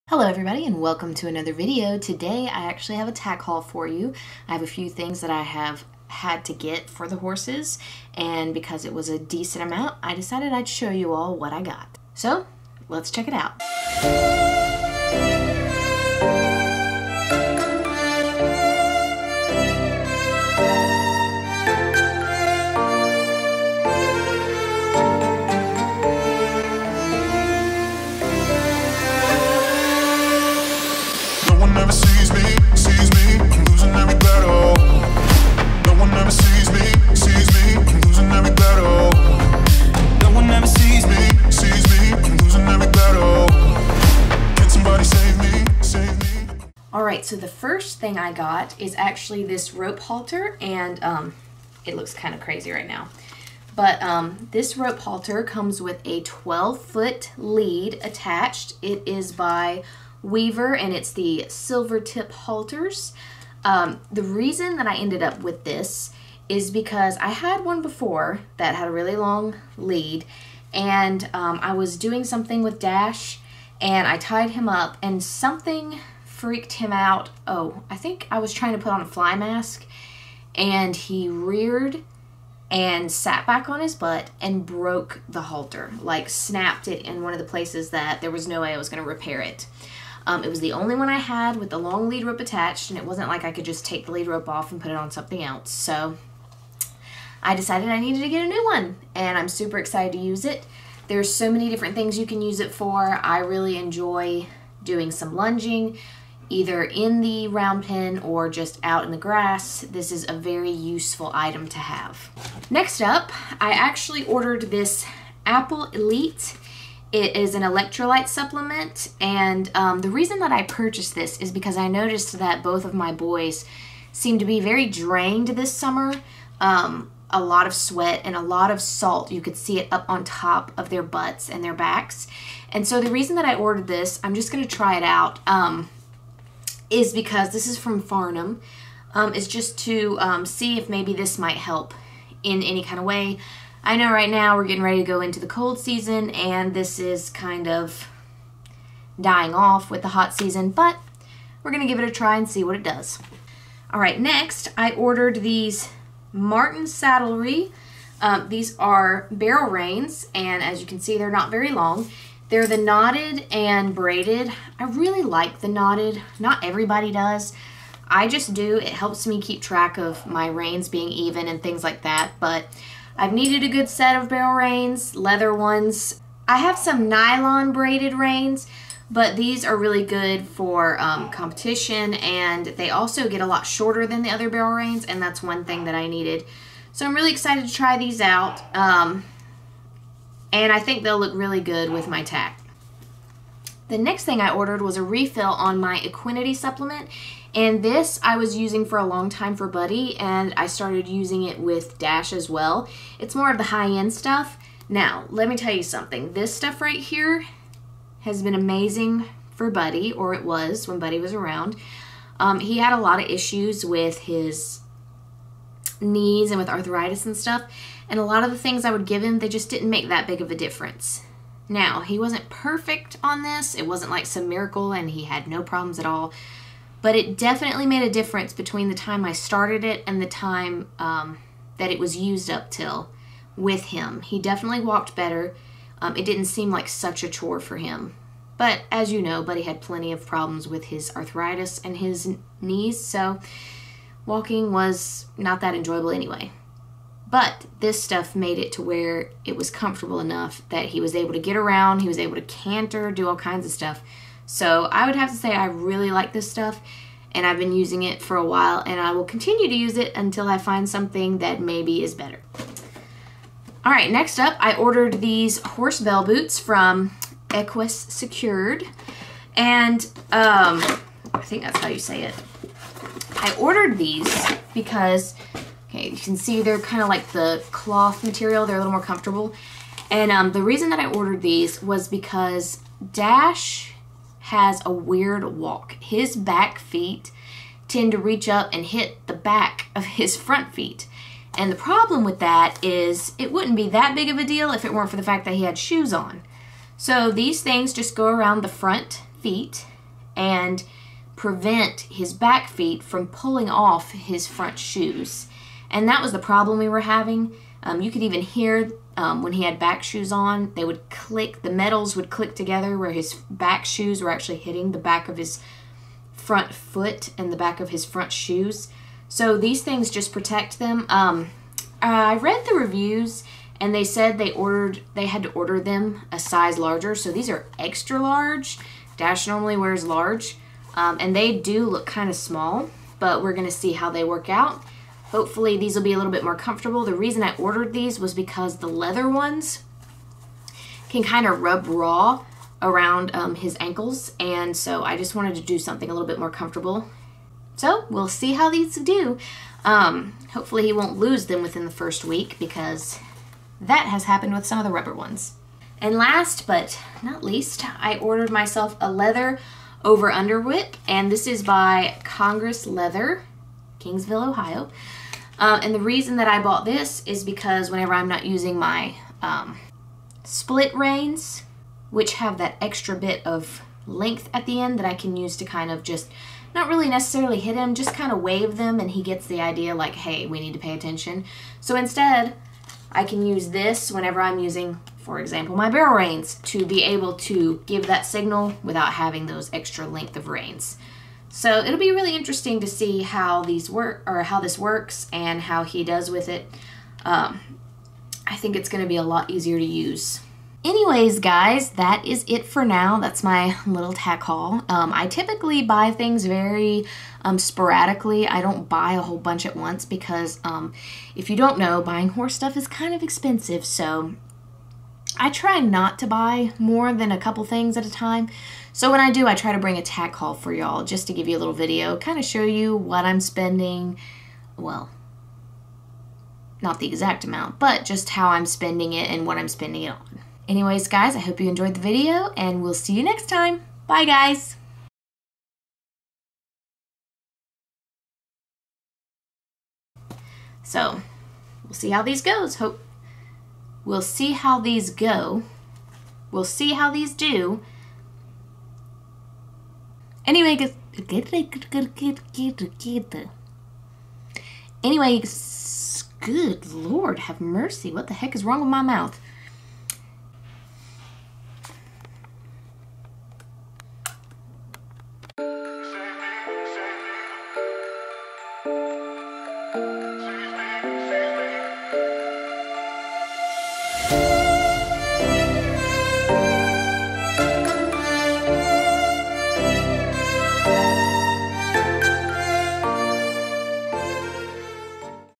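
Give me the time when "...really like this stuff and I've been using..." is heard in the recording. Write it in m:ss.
4:15.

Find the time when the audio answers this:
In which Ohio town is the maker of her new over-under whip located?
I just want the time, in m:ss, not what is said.
6:03.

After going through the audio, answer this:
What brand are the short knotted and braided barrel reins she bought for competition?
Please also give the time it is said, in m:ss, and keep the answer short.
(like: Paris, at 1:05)
Martin Saddlery, at 2:36.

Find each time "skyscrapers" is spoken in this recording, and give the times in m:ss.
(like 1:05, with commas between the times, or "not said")
not said.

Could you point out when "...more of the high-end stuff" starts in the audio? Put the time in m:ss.
3:23.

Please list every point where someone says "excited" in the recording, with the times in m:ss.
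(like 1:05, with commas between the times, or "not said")
1:39, 3:07.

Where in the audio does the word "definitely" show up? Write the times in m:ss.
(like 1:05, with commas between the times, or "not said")
3:47, 3:54.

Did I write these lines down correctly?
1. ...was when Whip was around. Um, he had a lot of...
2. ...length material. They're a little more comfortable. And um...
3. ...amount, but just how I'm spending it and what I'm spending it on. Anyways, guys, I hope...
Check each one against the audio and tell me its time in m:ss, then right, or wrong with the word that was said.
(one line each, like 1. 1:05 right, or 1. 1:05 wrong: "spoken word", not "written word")
1. 3:30 wrong: "Buddy", not "Whip"
2. 4:37 wrong: "cloth", not "length"
3. 7:07 right.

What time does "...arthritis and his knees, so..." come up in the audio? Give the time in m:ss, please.
4:01.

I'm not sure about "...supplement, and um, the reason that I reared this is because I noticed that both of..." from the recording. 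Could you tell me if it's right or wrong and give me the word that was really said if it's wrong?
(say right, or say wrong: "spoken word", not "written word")
wrong: "purchased", not "reared".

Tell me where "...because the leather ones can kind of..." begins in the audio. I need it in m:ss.
5:38.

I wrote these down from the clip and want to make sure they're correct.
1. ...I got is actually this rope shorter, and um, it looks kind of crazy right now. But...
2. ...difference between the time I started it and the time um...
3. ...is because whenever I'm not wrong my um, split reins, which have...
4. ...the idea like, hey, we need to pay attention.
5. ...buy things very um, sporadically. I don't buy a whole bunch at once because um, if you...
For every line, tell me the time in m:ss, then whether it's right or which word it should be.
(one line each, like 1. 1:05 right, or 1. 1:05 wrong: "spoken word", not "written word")
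1. 0:48 wrong: "halter", not "shorter"
2. 3:48 right
3. 6:07 wrong: "using", not "wrong"
4. 6:19 right
5. 6:45 right.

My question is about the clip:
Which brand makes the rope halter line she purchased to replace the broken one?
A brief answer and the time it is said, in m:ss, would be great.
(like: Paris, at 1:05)
Weaver, at 1:00.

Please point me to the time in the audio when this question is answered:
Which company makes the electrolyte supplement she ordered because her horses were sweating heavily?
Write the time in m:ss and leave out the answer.
2:18.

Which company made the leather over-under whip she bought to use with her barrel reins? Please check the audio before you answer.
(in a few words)
Congress Leather.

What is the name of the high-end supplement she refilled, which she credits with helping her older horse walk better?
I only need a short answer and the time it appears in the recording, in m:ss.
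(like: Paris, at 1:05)
Equinity, at 3:15.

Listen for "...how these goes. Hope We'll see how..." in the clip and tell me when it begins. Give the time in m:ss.
7:22.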